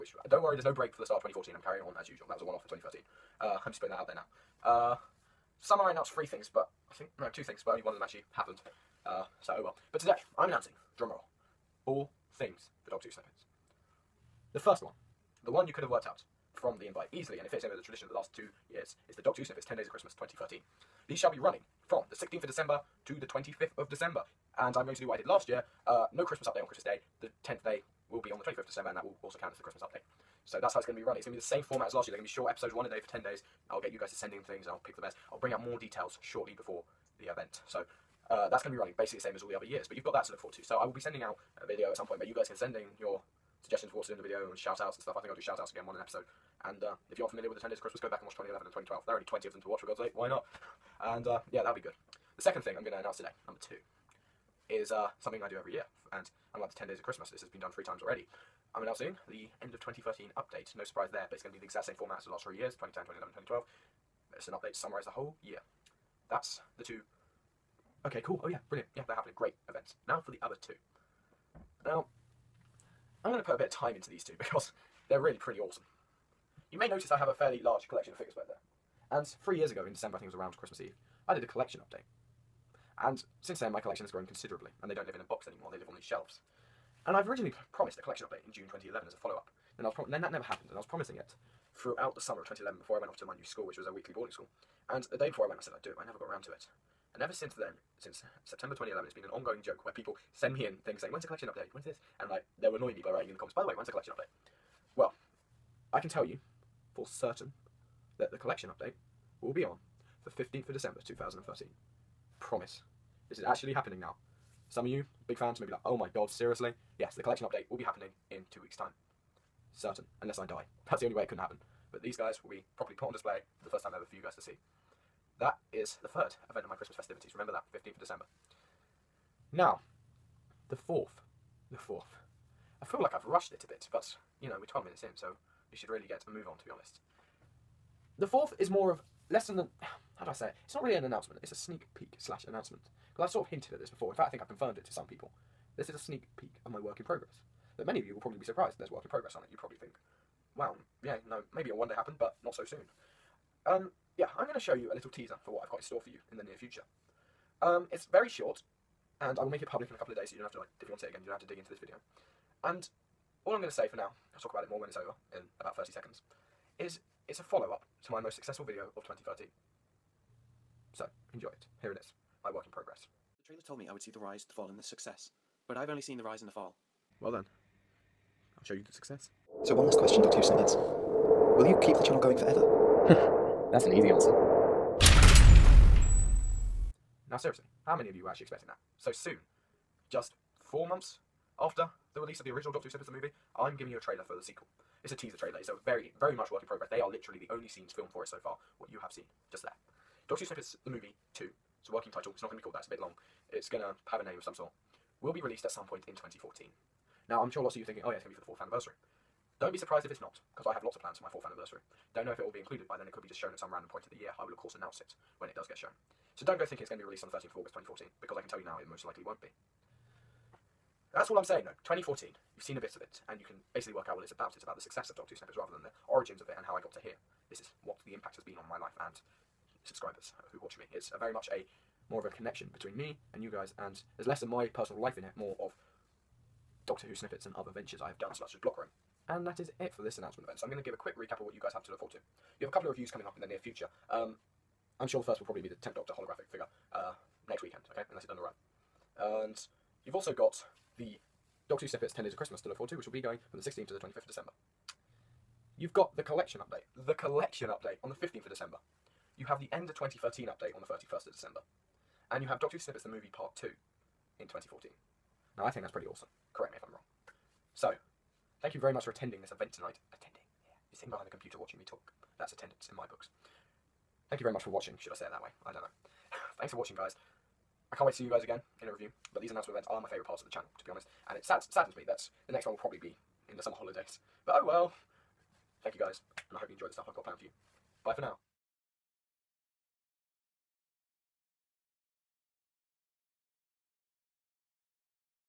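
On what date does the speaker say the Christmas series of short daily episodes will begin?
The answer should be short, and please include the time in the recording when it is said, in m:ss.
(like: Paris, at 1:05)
16th of December, at 0:22.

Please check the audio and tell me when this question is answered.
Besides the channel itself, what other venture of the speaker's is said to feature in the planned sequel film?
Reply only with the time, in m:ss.
3:58.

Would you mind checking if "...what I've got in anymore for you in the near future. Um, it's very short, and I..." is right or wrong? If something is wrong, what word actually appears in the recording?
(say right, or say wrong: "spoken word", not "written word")
wrong: "store", not "anymore".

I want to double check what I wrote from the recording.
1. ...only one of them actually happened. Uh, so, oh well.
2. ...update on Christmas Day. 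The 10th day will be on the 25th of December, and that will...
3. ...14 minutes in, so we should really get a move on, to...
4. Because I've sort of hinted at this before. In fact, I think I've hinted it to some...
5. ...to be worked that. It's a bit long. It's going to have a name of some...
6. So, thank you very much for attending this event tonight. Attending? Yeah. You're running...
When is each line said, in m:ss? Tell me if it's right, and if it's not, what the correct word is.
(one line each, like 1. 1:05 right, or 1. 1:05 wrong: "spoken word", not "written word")
1. 0:07 right
2. 0:26 right
3. 2:14 wrong: "12", not "14"
4. 2:23 wrong: "confirmed", not "hinted"
5. 3:22 wrong: "called", not "worked"
6. 4:27 wrong: "sitting", not "running".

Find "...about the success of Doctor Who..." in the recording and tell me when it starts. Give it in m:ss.
3:44.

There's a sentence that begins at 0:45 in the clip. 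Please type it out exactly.
I think I'll do shout outs again one an episode.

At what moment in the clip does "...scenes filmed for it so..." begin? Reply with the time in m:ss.
3:17.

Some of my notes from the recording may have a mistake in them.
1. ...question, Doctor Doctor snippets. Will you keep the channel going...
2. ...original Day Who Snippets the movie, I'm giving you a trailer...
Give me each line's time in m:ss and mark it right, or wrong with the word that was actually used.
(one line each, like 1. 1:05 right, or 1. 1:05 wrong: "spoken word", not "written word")
1. 2:59 wrong: "Who", not "Doctor"
2. 3:12 wrong: "Doctor", not "Day".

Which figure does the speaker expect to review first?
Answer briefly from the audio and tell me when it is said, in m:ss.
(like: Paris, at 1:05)
Tenth Doctor holographic figure, at 4:05.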